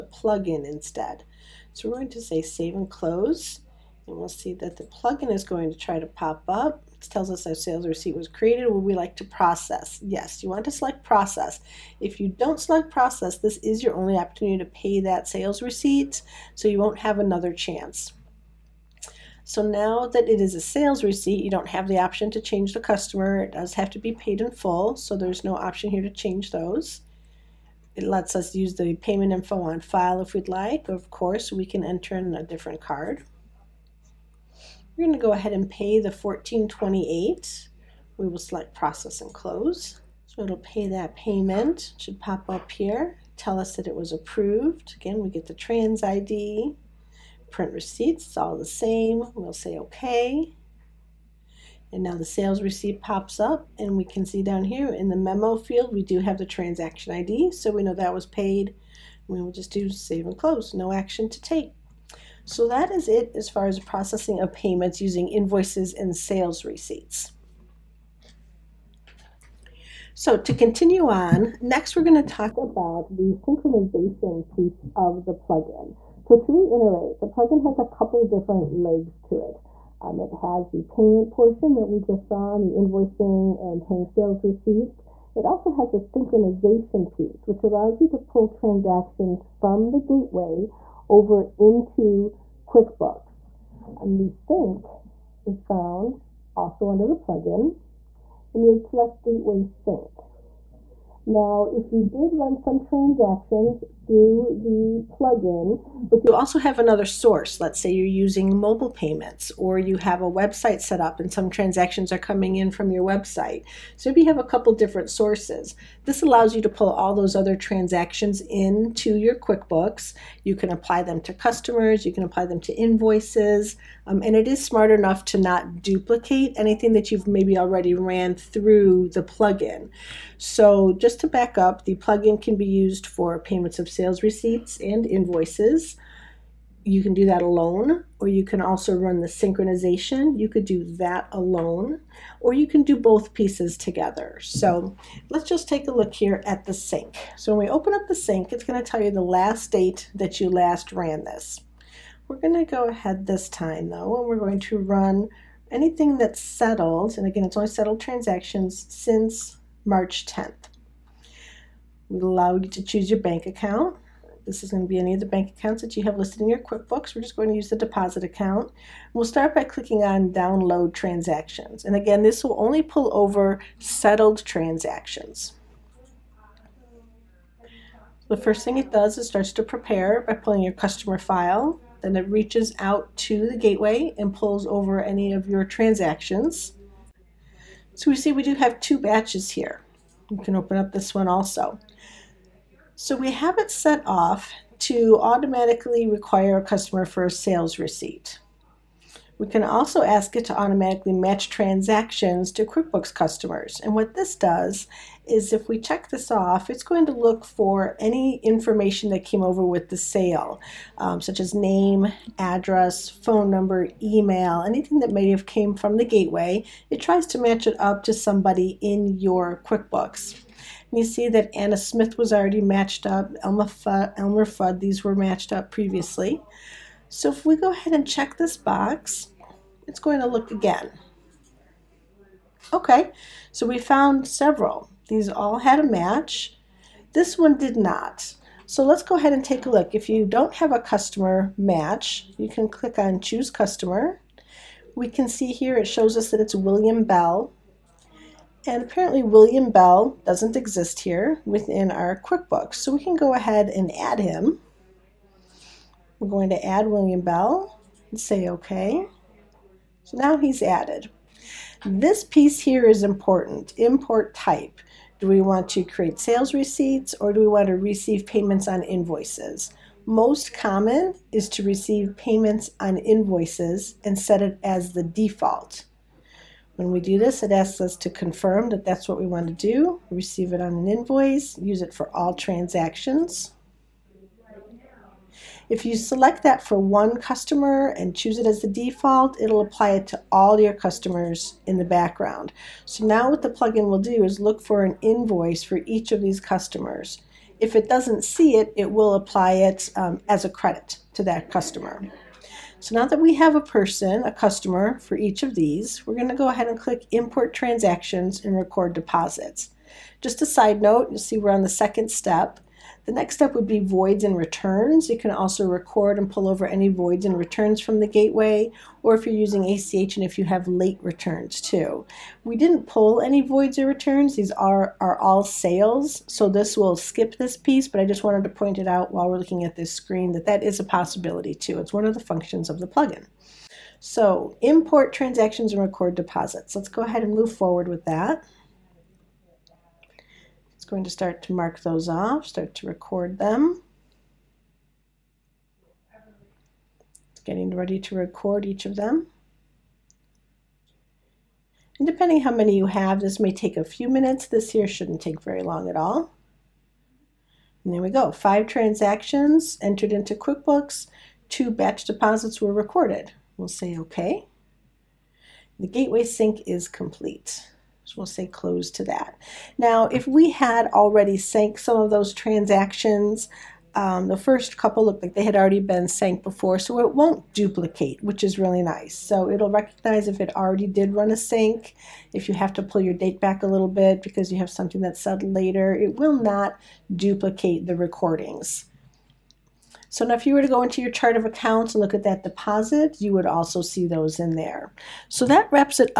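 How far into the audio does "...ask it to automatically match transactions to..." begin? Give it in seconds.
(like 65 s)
200 s.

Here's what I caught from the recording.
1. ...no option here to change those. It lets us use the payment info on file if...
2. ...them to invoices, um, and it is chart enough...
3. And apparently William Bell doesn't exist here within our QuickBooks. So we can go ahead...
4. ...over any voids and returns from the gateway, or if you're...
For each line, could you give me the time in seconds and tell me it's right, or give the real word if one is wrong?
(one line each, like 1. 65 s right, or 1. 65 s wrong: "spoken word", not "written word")
1. 25 s right
2. 122 s wrong: "smart", not "chart"
3. 248 s right
4. 316 s right.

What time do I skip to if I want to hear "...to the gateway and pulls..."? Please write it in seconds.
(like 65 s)
183 s.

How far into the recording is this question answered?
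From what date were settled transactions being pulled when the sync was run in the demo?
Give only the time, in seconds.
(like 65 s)
159 s.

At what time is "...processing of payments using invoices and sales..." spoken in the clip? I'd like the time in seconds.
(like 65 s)
63 s.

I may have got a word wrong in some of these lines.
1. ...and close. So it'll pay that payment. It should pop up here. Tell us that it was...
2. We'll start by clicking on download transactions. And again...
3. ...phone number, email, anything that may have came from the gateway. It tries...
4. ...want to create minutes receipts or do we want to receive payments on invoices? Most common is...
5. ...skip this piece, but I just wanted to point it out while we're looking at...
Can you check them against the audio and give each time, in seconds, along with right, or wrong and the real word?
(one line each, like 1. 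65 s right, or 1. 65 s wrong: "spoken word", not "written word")
1. 39 s right
2. 169 s right
3. 213 s right
4. 265 s wrong: "sales", not "minutes"
5. 326 s right.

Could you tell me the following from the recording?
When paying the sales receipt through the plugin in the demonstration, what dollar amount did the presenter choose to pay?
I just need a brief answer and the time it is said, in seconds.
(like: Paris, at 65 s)
$14.28, at 36 s.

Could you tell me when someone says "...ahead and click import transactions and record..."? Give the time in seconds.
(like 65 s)
306 s.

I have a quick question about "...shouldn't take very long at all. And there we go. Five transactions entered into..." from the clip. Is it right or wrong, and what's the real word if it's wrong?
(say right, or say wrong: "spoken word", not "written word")
right.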